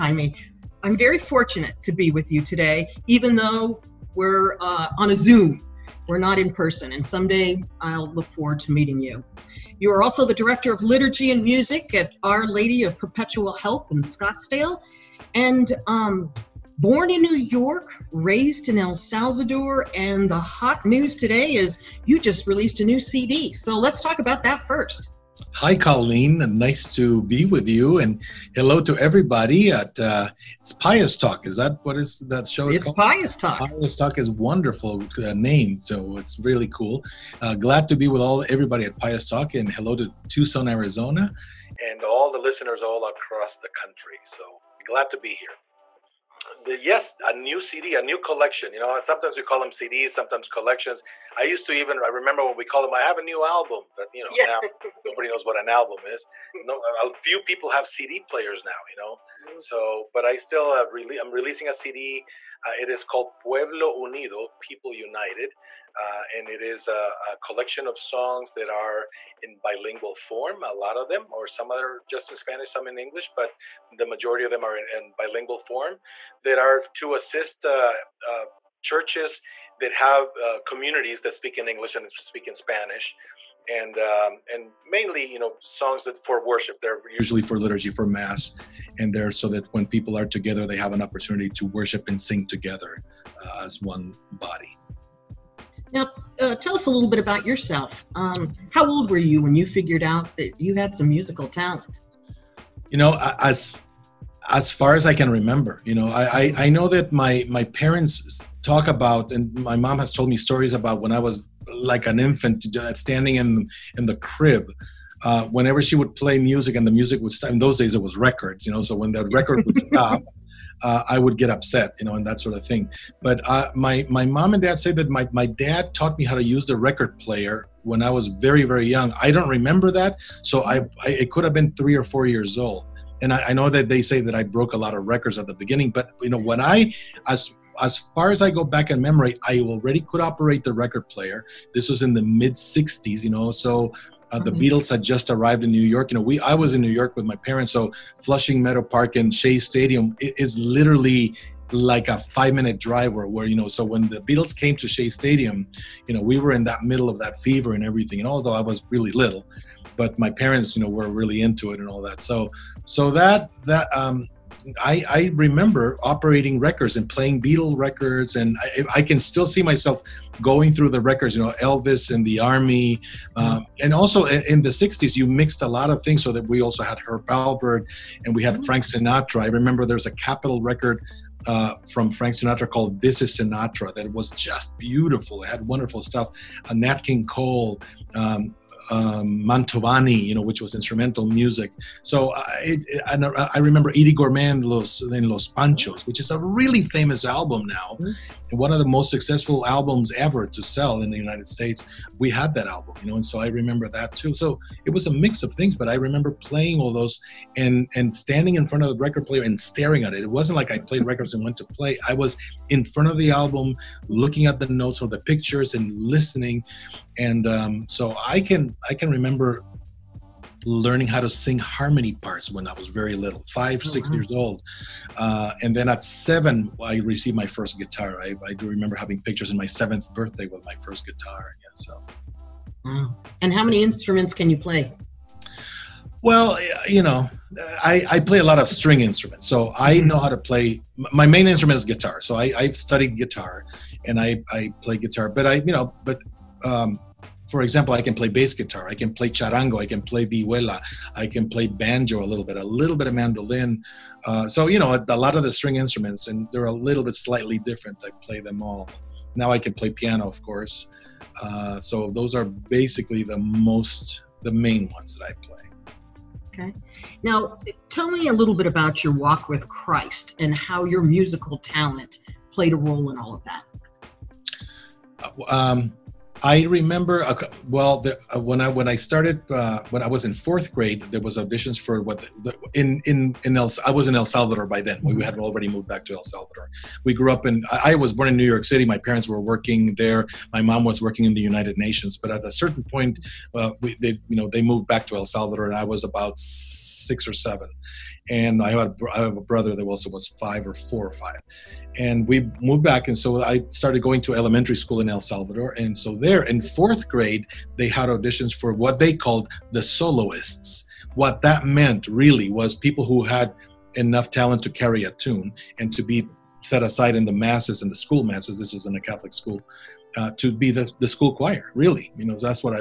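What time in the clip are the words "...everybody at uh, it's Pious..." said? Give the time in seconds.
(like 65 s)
28 s.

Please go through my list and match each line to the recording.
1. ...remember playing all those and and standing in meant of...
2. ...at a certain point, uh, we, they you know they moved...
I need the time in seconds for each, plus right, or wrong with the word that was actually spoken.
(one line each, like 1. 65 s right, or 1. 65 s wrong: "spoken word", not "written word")
1. 205 s wrong: "front", not "meant"
2. 292 s right.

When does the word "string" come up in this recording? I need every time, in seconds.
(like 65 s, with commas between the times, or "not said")
238 s, 255 s.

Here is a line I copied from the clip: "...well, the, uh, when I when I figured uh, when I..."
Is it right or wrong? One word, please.
wrong.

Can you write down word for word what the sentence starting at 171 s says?
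You know, Elvis and the Army, um, mm-hmm.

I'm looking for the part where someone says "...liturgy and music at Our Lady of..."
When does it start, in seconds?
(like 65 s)
10 s.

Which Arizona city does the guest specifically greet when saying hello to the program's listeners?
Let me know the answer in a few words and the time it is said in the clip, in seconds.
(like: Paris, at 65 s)
Tucson, at 40 s.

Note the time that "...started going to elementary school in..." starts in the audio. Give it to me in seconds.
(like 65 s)
303 s.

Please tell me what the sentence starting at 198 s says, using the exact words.
and one of the most successful albums ever to sell in the United States.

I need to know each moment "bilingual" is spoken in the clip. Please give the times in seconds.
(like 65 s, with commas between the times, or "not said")
69 s, 75 s.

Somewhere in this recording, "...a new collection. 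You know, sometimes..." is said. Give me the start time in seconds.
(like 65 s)
47 s.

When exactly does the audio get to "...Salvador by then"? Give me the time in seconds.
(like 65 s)
284 s.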